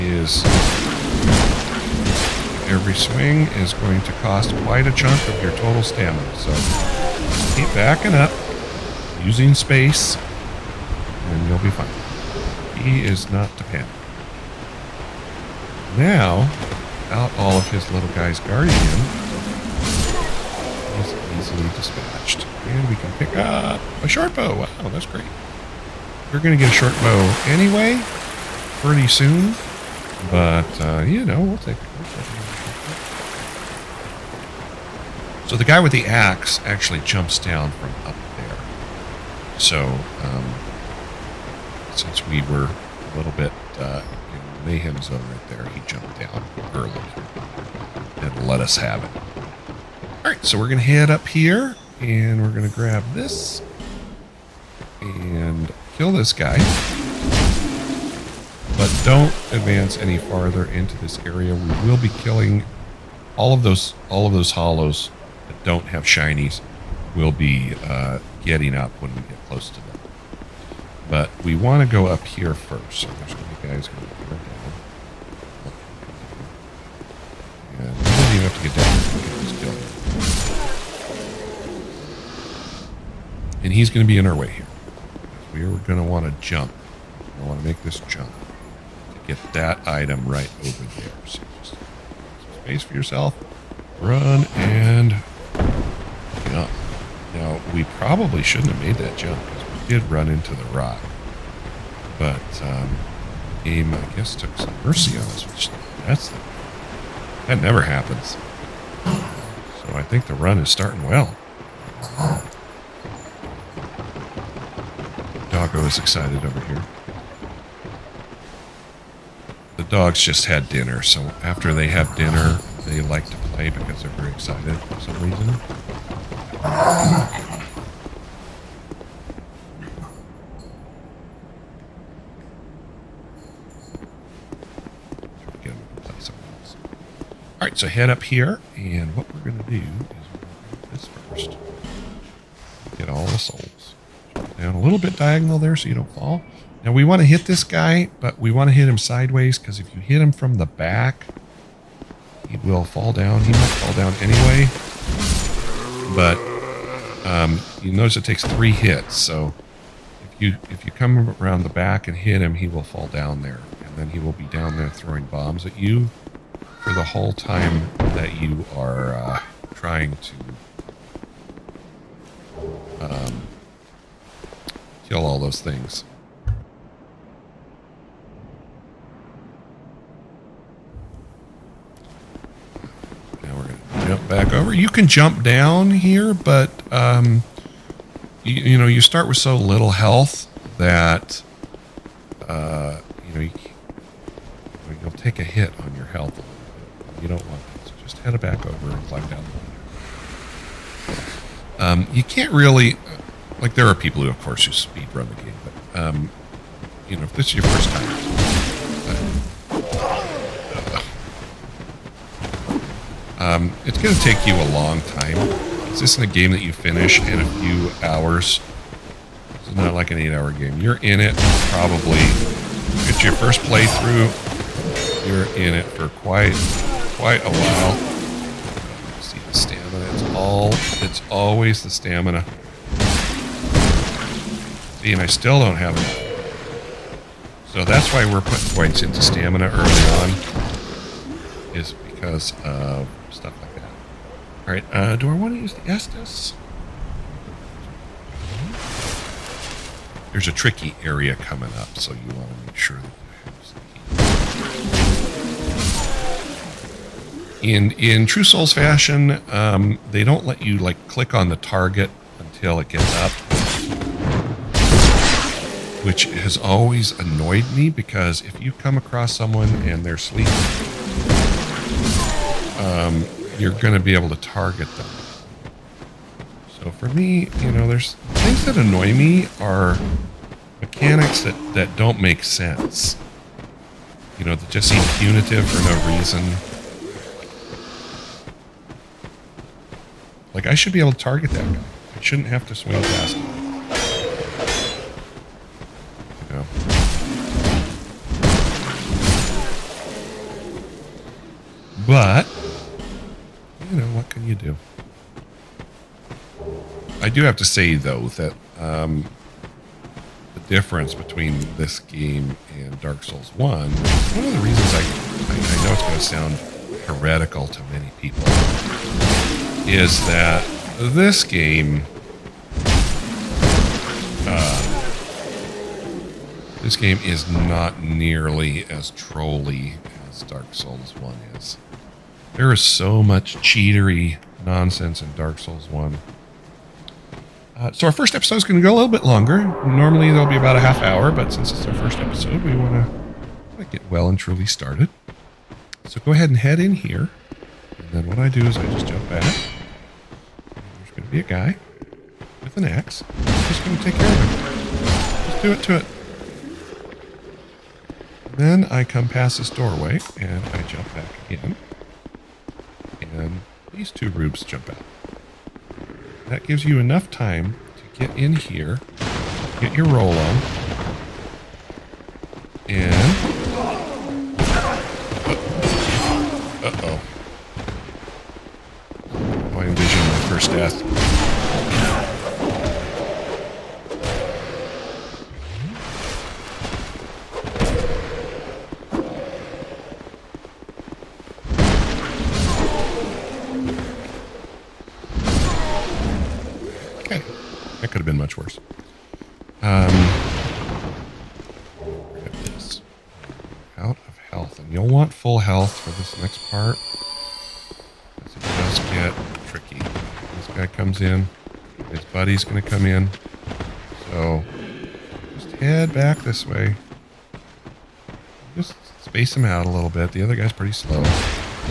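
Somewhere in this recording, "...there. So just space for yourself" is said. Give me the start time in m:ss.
1:30.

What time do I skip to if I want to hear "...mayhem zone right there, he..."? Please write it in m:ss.
0:44.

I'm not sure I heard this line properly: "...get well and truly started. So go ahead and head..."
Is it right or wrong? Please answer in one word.
right.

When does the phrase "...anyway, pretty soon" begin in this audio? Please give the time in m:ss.
0:27.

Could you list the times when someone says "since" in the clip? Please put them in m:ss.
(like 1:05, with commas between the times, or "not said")
0:41, 5:41.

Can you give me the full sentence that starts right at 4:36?
So for me, you know, there's things that annoy me are mechanics that that don't make sense.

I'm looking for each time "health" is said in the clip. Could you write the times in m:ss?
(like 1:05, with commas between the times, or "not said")
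3:09, 3:16.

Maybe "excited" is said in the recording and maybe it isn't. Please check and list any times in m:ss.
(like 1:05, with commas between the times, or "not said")
1:55, 2:04.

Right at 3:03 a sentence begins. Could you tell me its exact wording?
Now we're going to jump back over.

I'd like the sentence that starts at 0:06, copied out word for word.
So keep backing up, using space, and you'll be fine.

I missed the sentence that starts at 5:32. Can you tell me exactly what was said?
There is so much cheatery nonsense in Dark Souls 1.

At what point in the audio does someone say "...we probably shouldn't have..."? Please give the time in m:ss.
1:37.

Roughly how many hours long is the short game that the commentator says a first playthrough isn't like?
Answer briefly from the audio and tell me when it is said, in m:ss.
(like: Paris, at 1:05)
8 hours, at 3:40.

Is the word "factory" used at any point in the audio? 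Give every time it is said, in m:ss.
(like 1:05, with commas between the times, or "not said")
not said.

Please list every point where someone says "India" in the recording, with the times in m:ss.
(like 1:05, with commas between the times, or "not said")
not said.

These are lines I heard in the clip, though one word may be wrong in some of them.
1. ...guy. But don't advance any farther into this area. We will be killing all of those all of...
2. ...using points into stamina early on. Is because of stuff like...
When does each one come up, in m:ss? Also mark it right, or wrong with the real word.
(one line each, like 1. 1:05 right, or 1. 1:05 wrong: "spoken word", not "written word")
1. 0:56 right
2. 3:58 wrong: "putting", not "using".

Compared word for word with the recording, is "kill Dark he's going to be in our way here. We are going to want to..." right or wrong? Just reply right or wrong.
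wrong.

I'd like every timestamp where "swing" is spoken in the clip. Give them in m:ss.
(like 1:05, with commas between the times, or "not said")
0:02, 4:52.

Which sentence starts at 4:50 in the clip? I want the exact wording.
Like, I should be able to target that guy.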